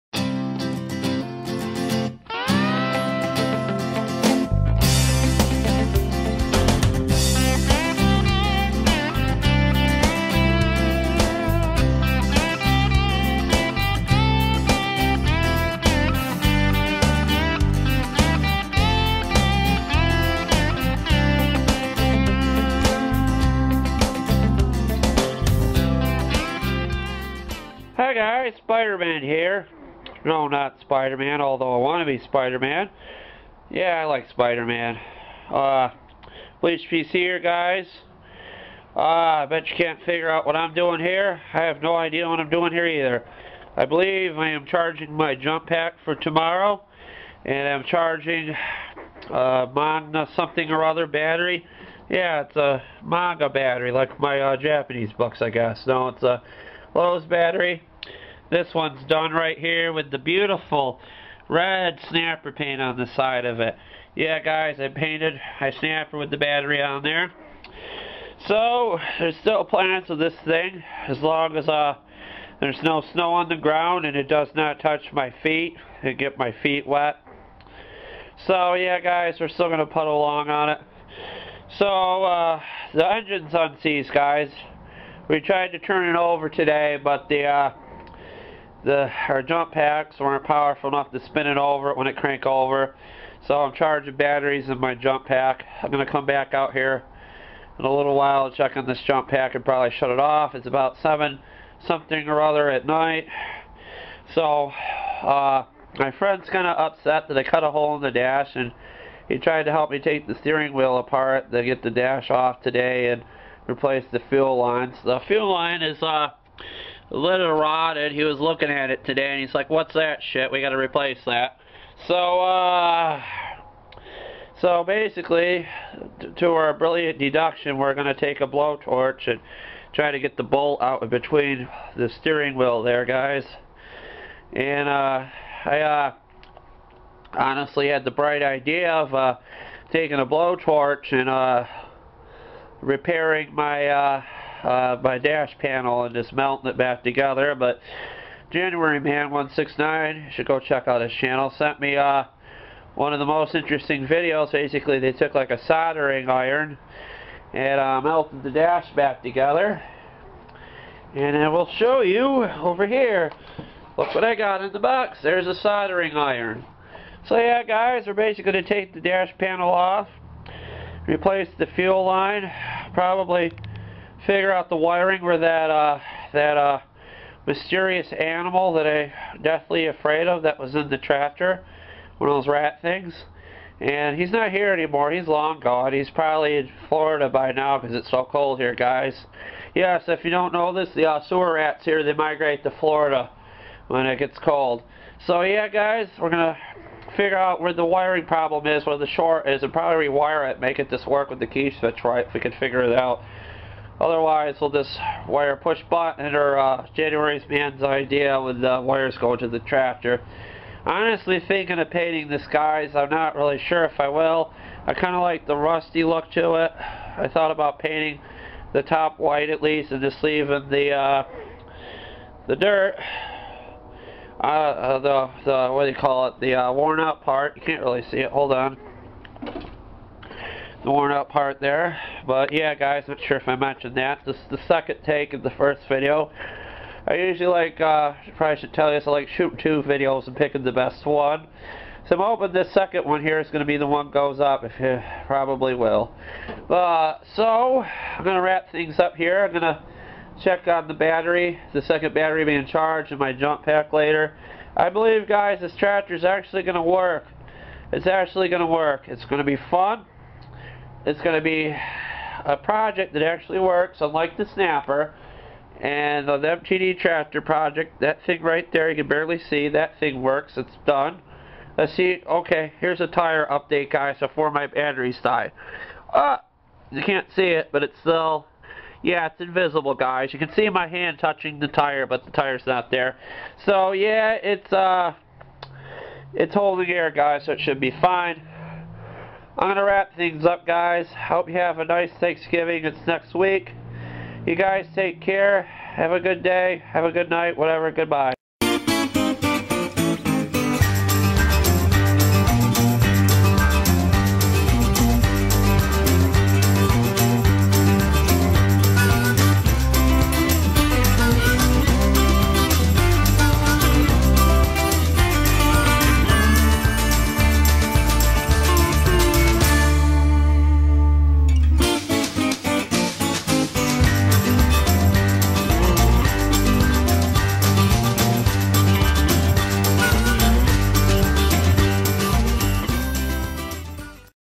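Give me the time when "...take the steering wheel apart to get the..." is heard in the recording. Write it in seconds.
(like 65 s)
109 s.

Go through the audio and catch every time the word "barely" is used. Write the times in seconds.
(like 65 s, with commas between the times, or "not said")
269 s.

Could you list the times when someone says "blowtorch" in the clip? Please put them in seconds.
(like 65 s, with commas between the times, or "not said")
128 s, 140 s.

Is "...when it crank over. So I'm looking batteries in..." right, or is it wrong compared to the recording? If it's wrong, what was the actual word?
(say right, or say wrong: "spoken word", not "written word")
wrong: "charging", not "looking".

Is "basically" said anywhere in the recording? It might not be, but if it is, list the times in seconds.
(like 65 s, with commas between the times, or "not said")
124 s, 154 s, 168 s.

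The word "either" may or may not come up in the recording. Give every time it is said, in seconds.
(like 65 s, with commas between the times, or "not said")
42 s.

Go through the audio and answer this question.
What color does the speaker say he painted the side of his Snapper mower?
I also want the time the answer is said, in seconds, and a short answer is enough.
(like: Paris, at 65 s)
red, at 61 s.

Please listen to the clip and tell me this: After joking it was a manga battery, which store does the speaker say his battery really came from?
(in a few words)
Lowe's.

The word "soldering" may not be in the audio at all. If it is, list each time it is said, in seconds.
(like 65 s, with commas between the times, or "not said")
155 s, 165 s.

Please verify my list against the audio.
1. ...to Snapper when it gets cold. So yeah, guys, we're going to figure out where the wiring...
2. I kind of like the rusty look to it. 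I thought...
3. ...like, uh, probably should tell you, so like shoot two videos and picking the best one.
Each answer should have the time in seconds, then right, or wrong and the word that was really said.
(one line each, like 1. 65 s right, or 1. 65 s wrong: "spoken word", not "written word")
1. 192 s wrong: "Florida", not "Snapper"
2. 214 s right
3. 237 s right.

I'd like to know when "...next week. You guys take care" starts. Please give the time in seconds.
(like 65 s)
293 s.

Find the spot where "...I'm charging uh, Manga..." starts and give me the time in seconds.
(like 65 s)
47 s.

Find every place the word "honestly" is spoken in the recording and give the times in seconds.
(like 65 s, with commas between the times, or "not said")
137 s, 210 s.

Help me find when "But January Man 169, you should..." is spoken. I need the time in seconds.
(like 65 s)
147 s.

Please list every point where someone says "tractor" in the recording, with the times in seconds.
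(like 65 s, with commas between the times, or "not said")
180 s, 209 s, 255 s, 266 s.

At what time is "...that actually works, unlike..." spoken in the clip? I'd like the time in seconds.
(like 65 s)
263 s.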